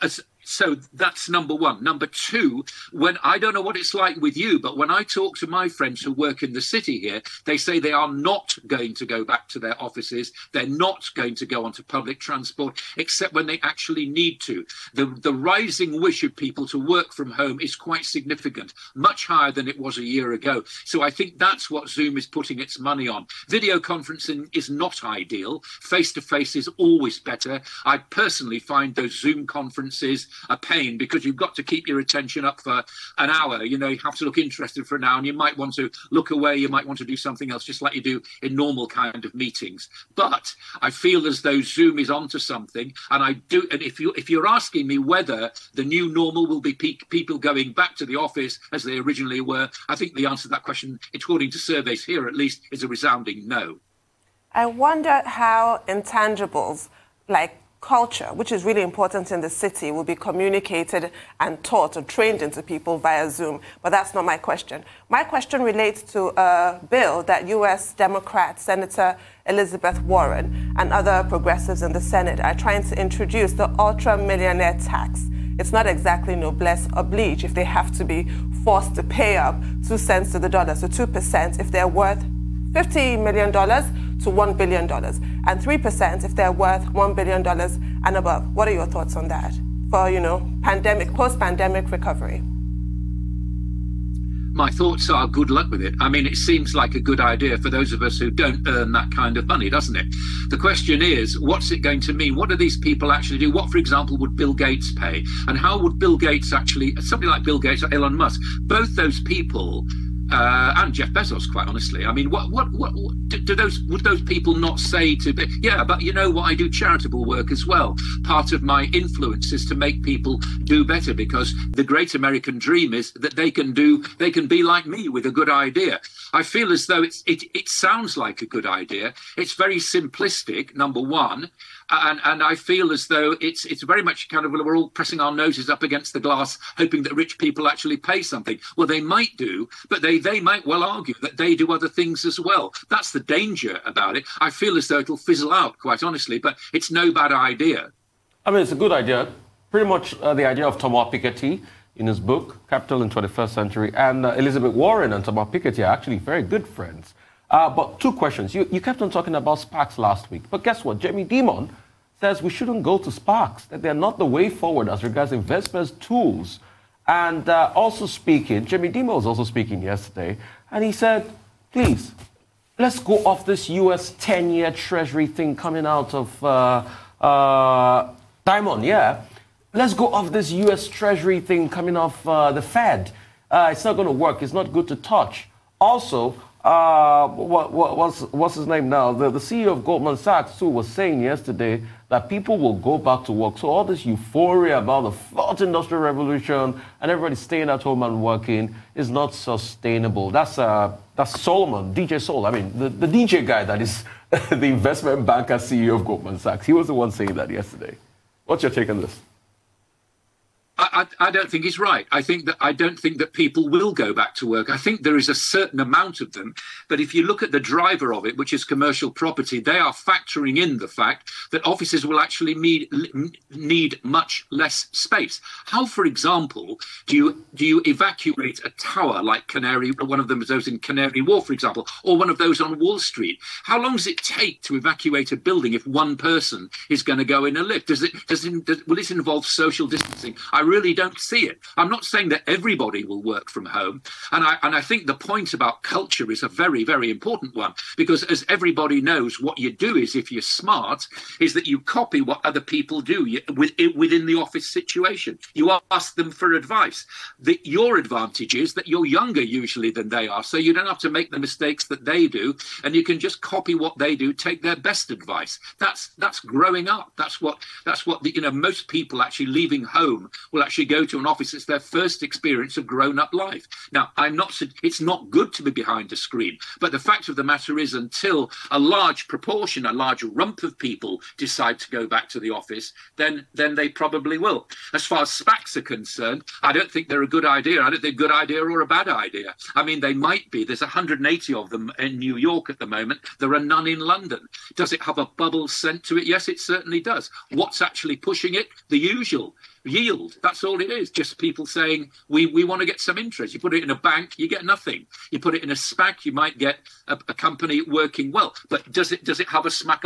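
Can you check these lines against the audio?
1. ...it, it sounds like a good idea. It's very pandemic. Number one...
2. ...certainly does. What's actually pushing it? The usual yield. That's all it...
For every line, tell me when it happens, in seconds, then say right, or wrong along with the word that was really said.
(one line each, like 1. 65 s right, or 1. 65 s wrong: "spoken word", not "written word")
1. 127 s wrong: "simplistic", not "pandemic"
2. 296 s right.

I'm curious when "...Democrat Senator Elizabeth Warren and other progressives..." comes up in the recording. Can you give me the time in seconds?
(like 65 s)
67 s.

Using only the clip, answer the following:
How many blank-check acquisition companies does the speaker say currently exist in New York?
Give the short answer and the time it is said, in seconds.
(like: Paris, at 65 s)
180, at 290 s.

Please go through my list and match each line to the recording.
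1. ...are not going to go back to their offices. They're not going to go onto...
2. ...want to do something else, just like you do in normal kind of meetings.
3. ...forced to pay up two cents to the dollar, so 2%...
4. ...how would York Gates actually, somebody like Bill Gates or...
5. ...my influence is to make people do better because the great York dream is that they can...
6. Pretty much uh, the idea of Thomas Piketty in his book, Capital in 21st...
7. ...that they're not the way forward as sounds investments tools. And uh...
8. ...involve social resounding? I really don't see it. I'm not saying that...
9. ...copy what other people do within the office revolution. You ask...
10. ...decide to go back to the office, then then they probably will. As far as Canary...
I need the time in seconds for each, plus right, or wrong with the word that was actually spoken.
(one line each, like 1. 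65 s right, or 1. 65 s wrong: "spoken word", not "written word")
1. 7 s right
2. 36 s right
3. 78 s right
4. 105 s wrong: "Bill", not "York"
5. 118 s wrong: "American", not "York"
6. 149 s right
7. 163 s wrong: "regards", not "sounds"
8. 239 s wrong: "distancing", not "resounding"
9. 251 s wrong: "situation", not "revolution"
10. 281 s wrong: "SPACs", not "Canary".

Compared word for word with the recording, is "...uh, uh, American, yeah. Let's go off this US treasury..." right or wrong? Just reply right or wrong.
wrong.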